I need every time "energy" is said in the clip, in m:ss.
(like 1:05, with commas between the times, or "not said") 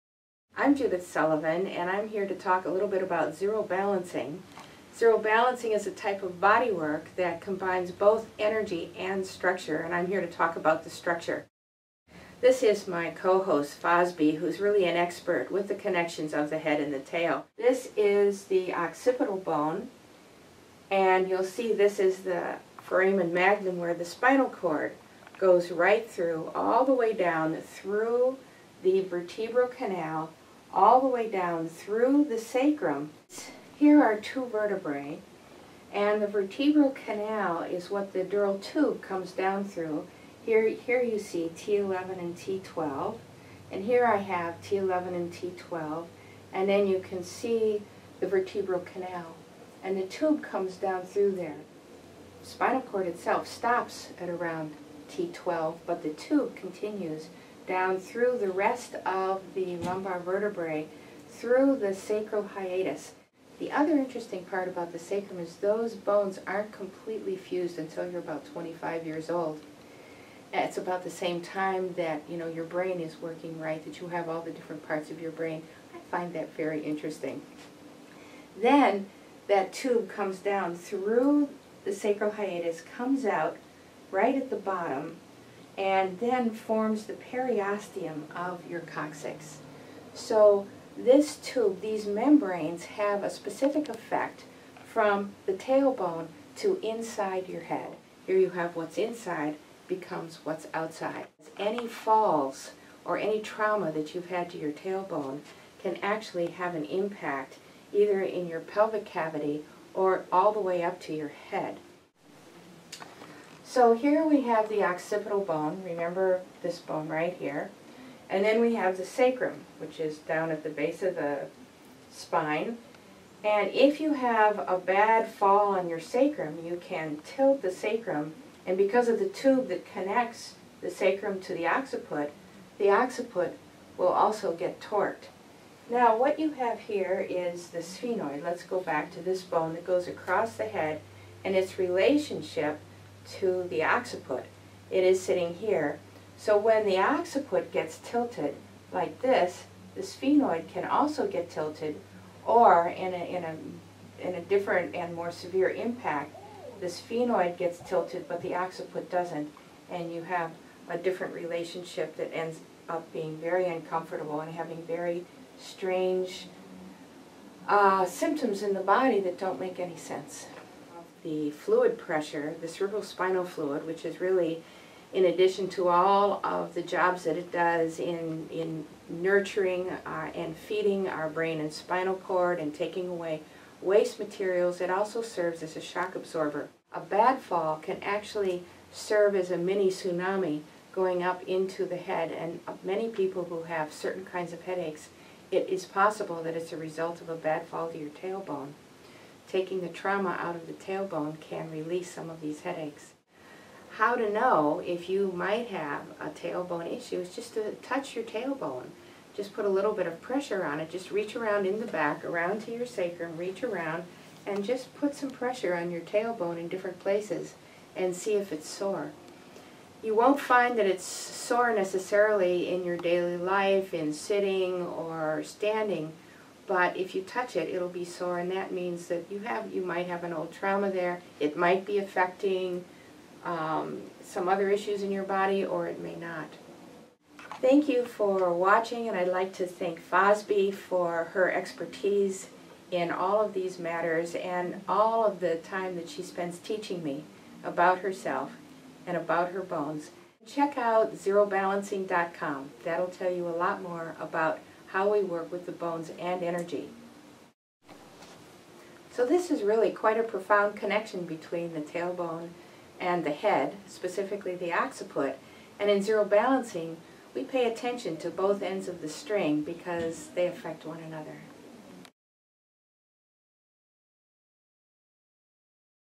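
0:08, 4:16.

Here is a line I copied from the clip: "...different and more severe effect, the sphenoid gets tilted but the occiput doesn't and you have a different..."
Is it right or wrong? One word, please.
wrong.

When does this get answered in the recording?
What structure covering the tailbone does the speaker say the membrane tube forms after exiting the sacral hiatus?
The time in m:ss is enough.
1:27.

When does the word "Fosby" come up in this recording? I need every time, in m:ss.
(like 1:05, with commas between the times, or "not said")
0:13, 4:00.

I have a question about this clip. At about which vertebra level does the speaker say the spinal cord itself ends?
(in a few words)
T12.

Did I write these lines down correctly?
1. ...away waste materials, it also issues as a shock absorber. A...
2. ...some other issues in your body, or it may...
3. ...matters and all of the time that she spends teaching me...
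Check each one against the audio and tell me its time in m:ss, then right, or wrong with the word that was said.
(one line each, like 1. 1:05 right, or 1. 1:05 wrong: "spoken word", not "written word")
1. 3:03 wrong: "serves", not "issues"
2. 3:54 right
3. 4:03 right.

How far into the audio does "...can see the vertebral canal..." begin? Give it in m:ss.
0:46.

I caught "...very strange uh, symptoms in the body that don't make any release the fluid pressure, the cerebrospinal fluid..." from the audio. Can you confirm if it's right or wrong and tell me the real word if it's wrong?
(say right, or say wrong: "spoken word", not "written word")
wrong: "sense", not "release".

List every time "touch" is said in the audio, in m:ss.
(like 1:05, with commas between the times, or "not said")
3:27, 3:47.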